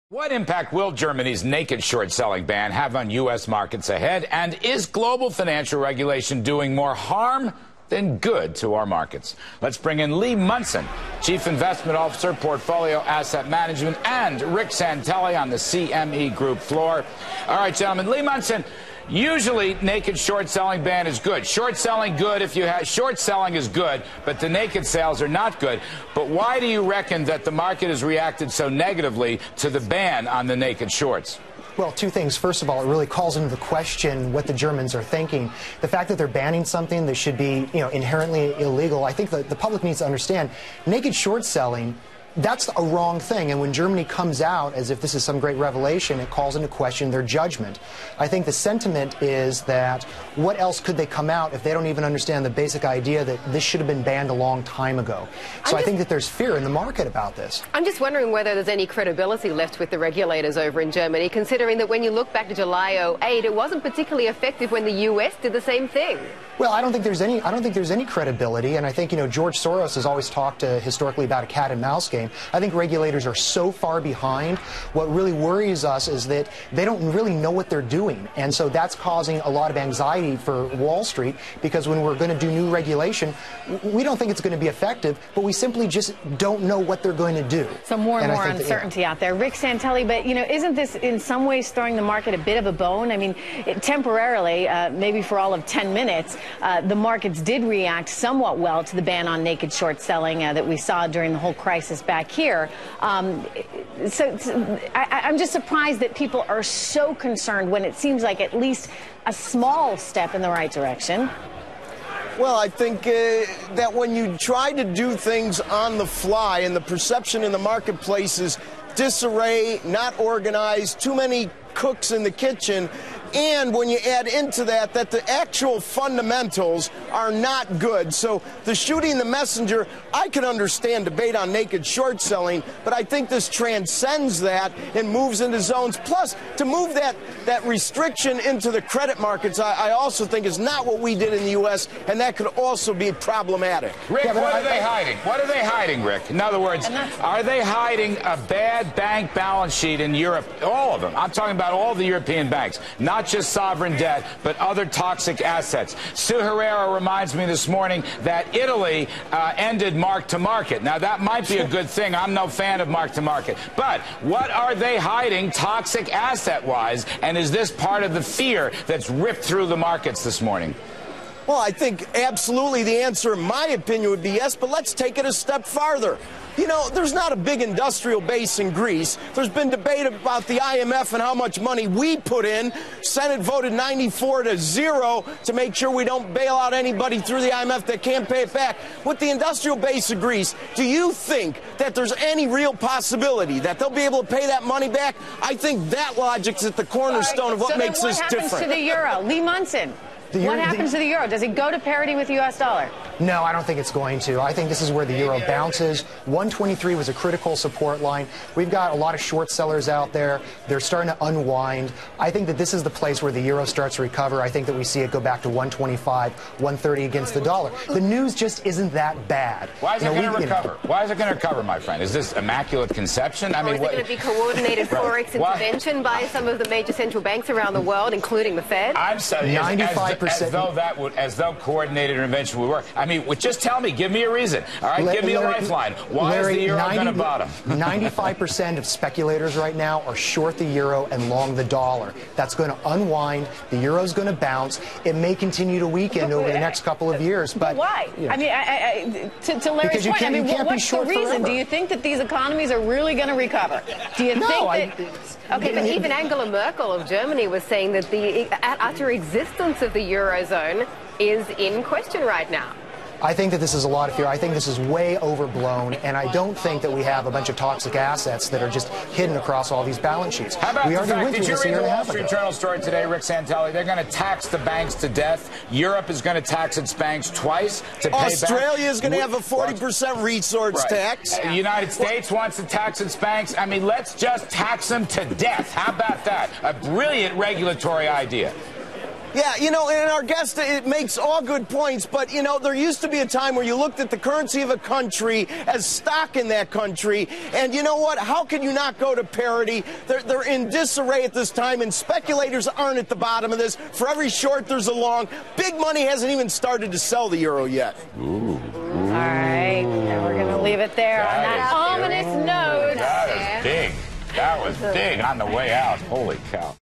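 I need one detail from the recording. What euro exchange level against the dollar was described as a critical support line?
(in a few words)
123.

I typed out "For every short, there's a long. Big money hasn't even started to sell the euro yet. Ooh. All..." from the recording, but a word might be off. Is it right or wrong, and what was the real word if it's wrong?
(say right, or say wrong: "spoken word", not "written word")
right.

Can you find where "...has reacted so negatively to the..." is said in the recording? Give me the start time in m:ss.
0:27.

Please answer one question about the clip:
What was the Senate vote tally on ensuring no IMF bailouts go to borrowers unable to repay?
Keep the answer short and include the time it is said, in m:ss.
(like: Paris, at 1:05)
94 to 0, at 3:03.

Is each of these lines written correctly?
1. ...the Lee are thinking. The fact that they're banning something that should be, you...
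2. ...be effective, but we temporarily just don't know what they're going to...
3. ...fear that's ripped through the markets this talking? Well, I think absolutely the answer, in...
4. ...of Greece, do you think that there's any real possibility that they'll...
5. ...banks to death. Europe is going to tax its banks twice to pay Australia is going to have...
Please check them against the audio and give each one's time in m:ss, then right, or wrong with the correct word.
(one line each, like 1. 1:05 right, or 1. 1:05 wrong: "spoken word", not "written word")
1. 0:34 wrong: "Germans", not "Lee"
2. 1:24 wrong: "simply", not "temporarily"
3. 2:48 wrong: "morning", not "talking"
4. 3:10 right
5. 4:34 right.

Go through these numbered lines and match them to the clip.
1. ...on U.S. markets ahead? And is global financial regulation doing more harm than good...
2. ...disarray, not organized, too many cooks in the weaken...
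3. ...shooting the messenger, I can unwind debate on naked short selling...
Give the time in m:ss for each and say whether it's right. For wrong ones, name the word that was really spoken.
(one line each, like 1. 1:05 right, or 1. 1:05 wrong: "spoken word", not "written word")
1. 0:02 right
2. 1:58 wrong: "kitchen", not "weaken"
3. 2:08 wrong: "understand", not "unwind".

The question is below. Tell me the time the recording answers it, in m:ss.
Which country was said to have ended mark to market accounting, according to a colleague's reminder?
2:38.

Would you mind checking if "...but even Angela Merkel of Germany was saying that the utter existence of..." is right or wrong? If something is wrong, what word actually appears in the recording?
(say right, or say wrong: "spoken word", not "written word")
right.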